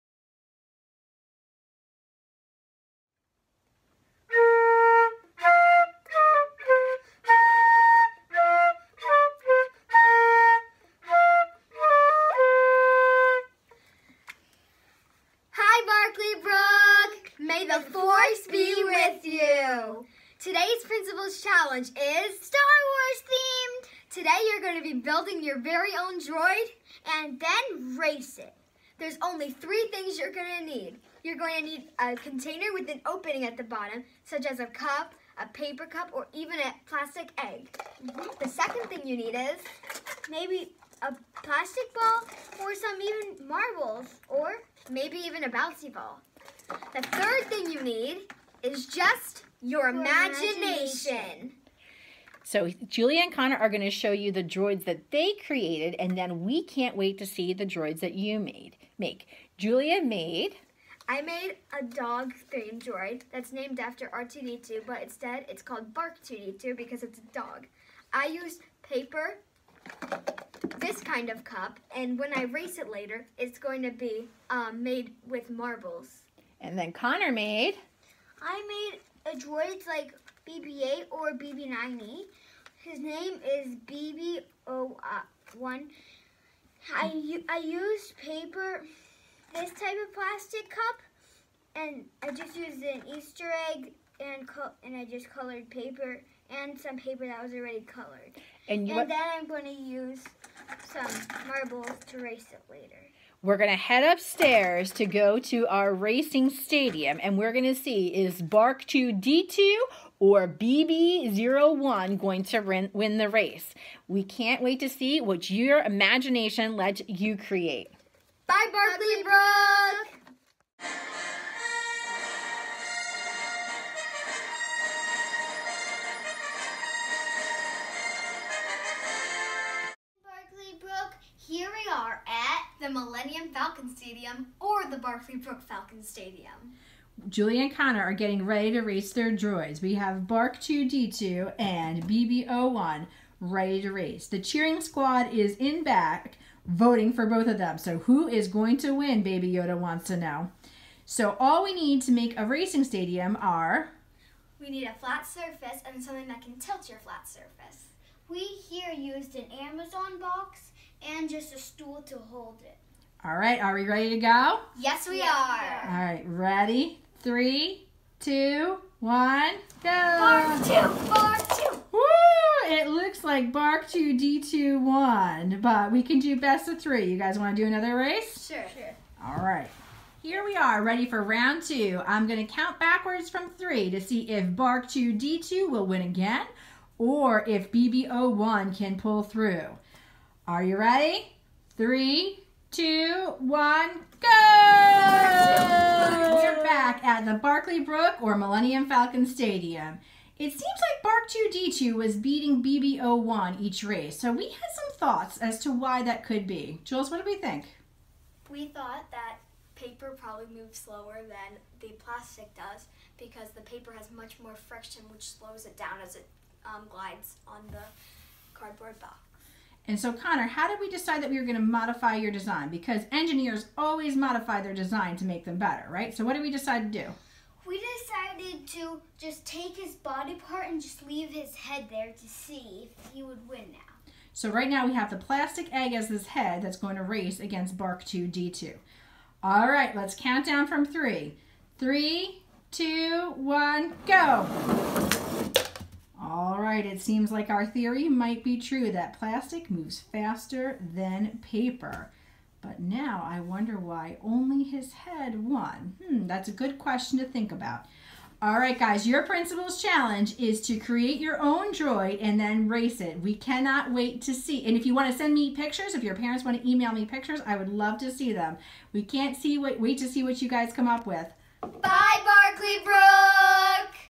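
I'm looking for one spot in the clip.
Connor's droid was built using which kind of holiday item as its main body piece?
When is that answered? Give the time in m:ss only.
1:33.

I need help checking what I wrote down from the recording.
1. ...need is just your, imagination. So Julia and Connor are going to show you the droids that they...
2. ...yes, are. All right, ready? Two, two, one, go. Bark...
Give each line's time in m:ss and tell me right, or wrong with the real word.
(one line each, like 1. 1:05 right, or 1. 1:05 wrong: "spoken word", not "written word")
1. 0:47 right
2. 2:45 wrong: "Three", not "Two".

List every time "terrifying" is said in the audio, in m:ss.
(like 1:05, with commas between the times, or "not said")
not said.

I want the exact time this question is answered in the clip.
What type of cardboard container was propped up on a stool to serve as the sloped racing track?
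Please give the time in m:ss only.
2:39.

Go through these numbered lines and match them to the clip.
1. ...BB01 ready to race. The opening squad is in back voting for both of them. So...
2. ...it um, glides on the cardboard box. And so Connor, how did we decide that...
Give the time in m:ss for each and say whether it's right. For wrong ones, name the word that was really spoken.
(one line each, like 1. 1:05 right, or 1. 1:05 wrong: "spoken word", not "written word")
1. 2:22 wrong: "cheering", not "opening"
2. 3:36 right.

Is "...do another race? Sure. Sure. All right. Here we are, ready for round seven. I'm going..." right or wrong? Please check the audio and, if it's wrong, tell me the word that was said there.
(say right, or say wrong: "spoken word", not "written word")
wrong: "two", not "seven".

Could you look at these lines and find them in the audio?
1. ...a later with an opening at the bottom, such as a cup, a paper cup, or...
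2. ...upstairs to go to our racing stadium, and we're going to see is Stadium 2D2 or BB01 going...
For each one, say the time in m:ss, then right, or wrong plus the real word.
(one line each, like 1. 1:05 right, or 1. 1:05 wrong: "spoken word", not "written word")
1. 0:31 wrong: "container", not "later"
2. 1:44 wrong: "Bark", not "Stadium".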